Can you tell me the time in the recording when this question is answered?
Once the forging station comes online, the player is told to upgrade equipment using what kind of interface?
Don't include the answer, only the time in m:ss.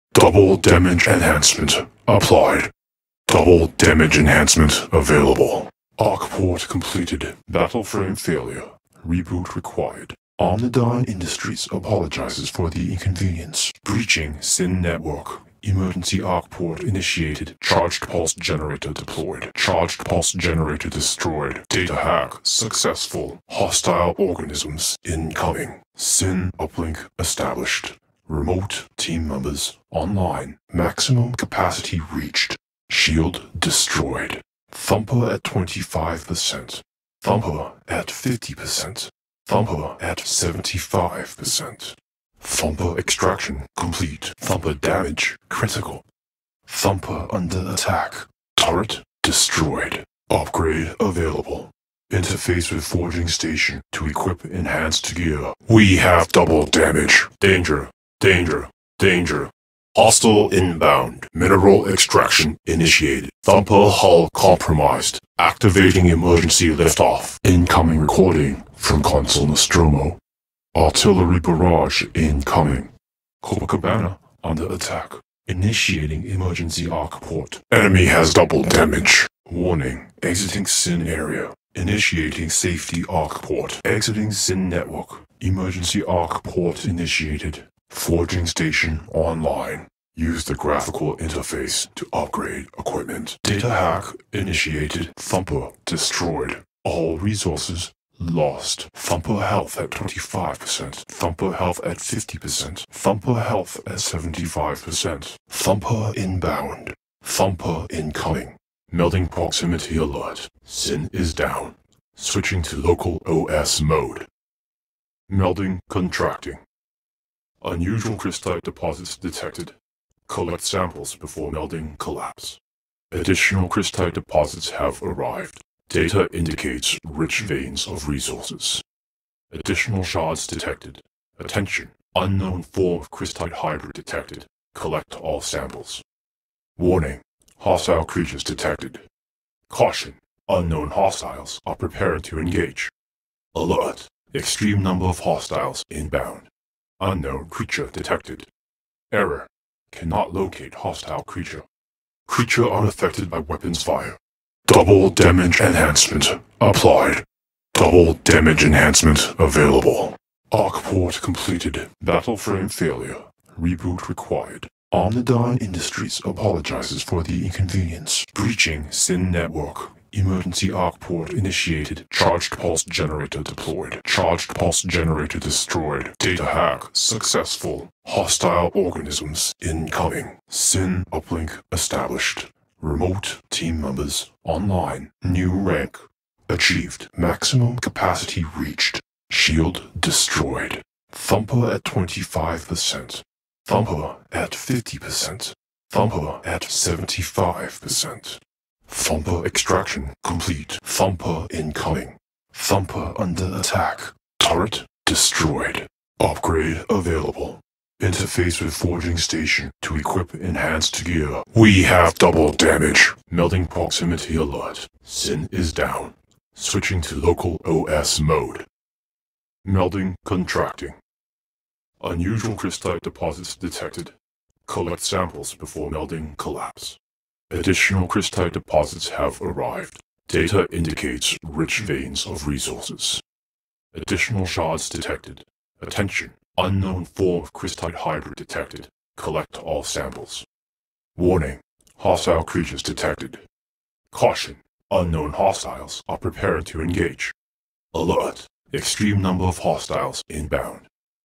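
1:30.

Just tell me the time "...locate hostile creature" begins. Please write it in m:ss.
2:30.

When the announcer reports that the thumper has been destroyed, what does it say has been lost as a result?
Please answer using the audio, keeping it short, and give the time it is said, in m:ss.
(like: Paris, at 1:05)
All resources, at 1:36.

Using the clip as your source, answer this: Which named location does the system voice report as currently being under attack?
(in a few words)
Copacabana.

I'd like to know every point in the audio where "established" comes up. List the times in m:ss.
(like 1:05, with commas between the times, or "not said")
0:27, 3:01.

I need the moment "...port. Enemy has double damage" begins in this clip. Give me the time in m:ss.
1:17.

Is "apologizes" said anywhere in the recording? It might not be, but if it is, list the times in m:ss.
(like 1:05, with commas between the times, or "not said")
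0:11, 2:46.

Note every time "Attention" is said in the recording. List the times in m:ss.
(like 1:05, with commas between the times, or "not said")
2:11, 3:55.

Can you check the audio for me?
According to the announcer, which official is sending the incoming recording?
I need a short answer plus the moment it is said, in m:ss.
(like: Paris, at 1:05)
Consul Nostromo, at 1:09.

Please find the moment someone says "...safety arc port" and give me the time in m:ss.
1:22.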